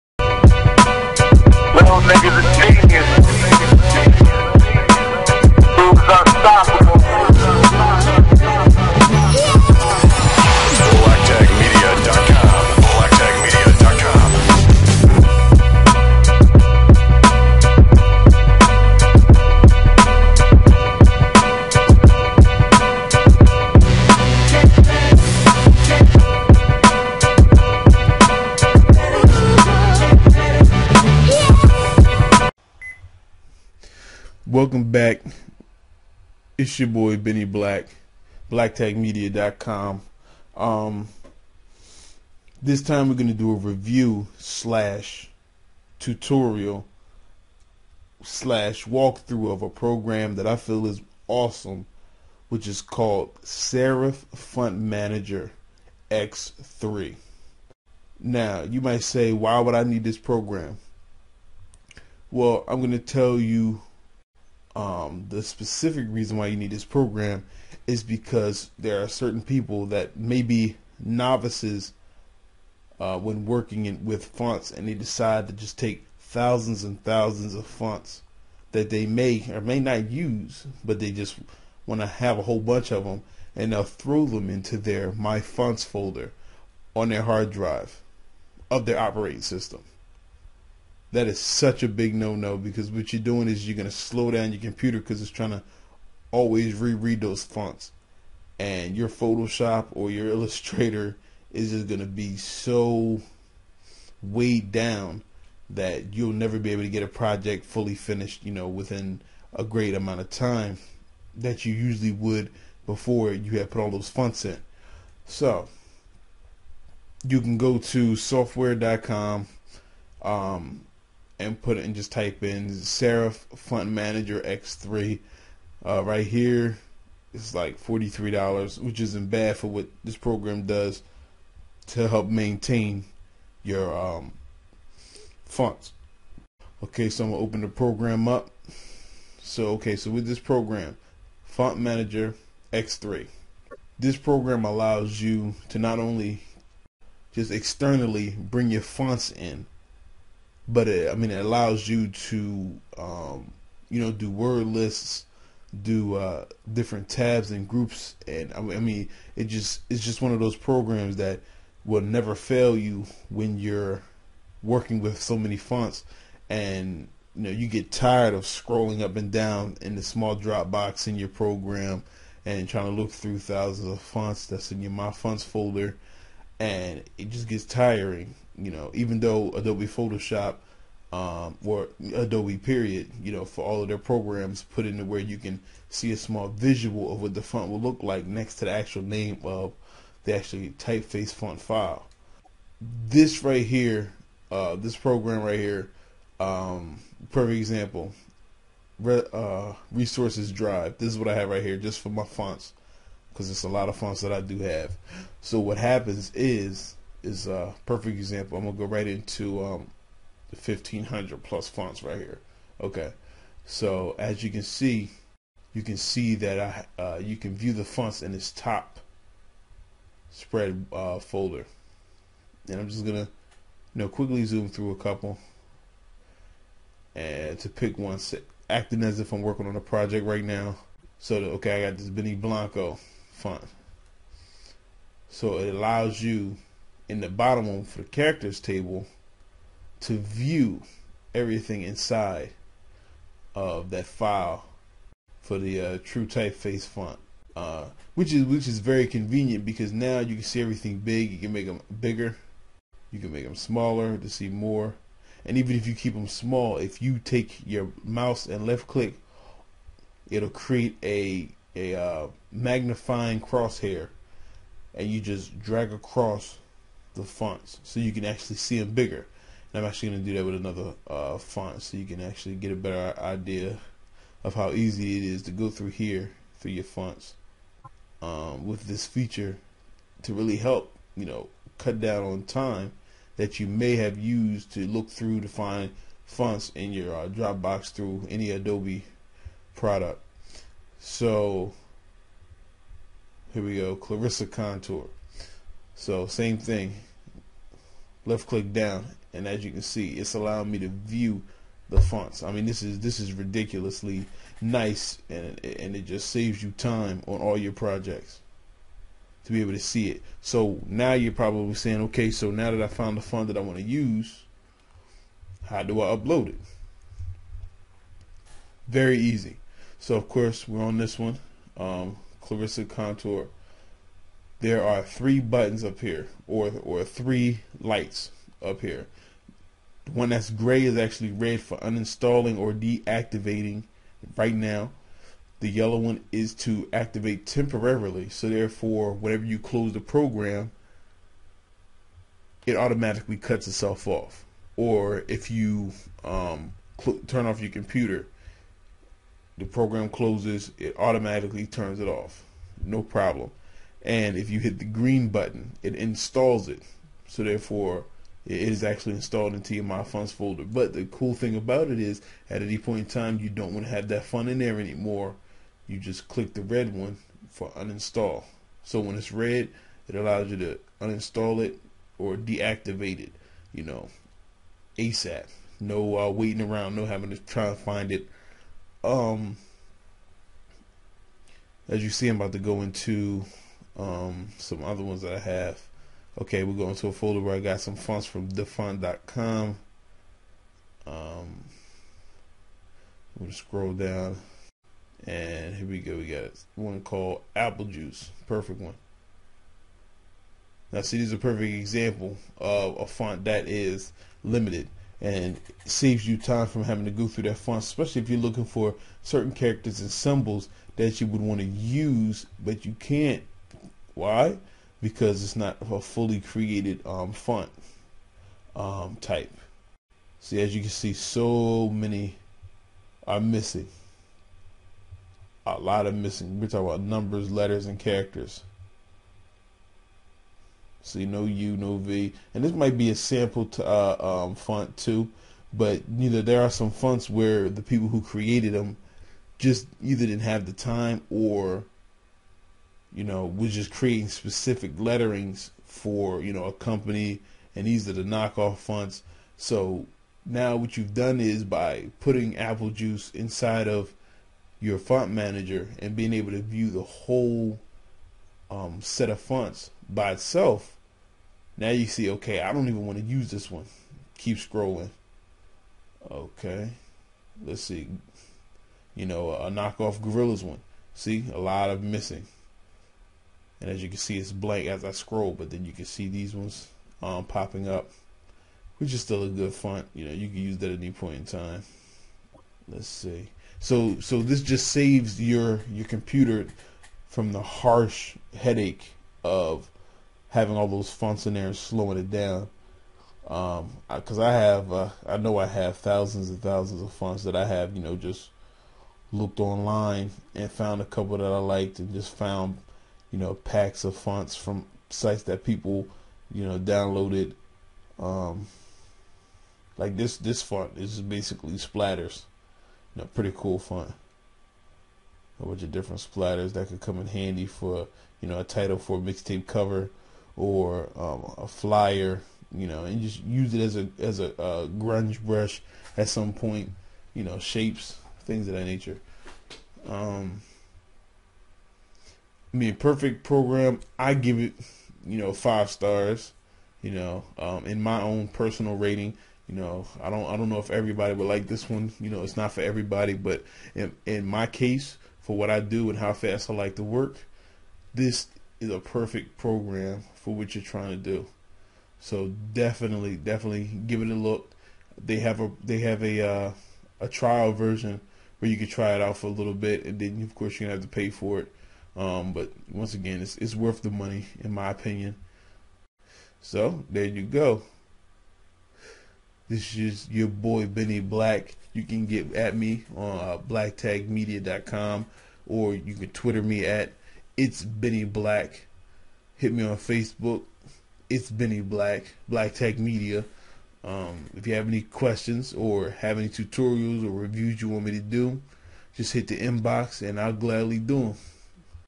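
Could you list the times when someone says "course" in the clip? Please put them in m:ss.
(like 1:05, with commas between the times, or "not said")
5:20, 9:20.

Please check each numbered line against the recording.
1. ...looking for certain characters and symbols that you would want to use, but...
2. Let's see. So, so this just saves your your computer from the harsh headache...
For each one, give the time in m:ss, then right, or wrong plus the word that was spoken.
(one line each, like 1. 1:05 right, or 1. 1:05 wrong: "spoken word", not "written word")
1. 6:48 right
2. 8:02 right.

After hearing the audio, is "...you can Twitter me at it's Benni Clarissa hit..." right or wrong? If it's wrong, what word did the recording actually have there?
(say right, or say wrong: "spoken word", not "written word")
wrong: "Black", not "Clarissa".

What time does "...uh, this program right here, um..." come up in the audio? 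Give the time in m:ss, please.
3:14.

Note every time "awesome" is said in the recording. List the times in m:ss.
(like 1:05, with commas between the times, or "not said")
0:51.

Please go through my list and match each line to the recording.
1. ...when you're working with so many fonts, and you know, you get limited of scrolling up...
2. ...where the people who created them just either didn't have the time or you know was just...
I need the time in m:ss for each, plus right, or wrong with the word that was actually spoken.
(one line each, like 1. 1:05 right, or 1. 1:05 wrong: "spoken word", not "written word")
1. 2:43 wrong: "tired", not "limited"
2. 7:17 right.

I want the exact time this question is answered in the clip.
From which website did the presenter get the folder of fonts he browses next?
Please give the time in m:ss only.
6:28.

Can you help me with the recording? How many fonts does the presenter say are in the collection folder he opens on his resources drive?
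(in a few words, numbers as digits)
1500 plus.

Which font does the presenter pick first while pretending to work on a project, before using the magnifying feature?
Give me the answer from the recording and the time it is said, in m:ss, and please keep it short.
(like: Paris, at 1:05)
Benny Blanco, at 3:52.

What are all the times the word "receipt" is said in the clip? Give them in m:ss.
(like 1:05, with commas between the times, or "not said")
not said.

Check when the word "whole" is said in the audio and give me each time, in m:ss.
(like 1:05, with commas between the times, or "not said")
1:22, 7:37.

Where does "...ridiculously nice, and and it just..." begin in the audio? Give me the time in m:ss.
5:03.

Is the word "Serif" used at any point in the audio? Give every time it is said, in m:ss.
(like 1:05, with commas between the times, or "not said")
0:53, 2:02.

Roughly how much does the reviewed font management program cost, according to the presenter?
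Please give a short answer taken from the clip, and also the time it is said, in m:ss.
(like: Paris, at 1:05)
$43, at 2:07.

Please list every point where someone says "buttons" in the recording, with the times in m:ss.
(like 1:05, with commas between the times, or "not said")
5:25, 5:55.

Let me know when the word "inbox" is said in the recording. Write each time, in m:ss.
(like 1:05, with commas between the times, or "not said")
9:49.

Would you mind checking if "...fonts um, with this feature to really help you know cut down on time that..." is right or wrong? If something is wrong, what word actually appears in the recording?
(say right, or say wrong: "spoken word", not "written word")
right.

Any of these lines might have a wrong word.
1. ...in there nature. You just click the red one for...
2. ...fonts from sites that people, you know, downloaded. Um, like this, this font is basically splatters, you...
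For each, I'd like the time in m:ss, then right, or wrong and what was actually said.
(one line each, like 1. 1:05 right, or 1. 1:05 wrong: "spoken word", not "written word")
1. 6:04 wrong: "anymore", not "nature"
2. 8:24 right.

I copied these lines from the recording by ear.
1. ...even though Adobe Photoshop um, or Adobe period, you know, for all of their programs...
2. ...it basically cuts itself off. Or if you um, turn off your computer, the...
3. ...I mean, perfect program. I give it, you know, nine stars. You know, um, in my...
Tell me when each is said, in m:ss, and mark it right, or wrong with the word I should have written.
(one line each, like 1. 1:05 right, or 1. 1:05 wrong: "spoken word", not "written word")
1. 2:58 right
2. 5:42 wrong: "automatically", not "basically"
3. 8:52 wrong: "five", not "nine".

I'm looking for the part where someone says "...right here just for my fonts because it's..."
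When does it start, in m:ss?
3:21.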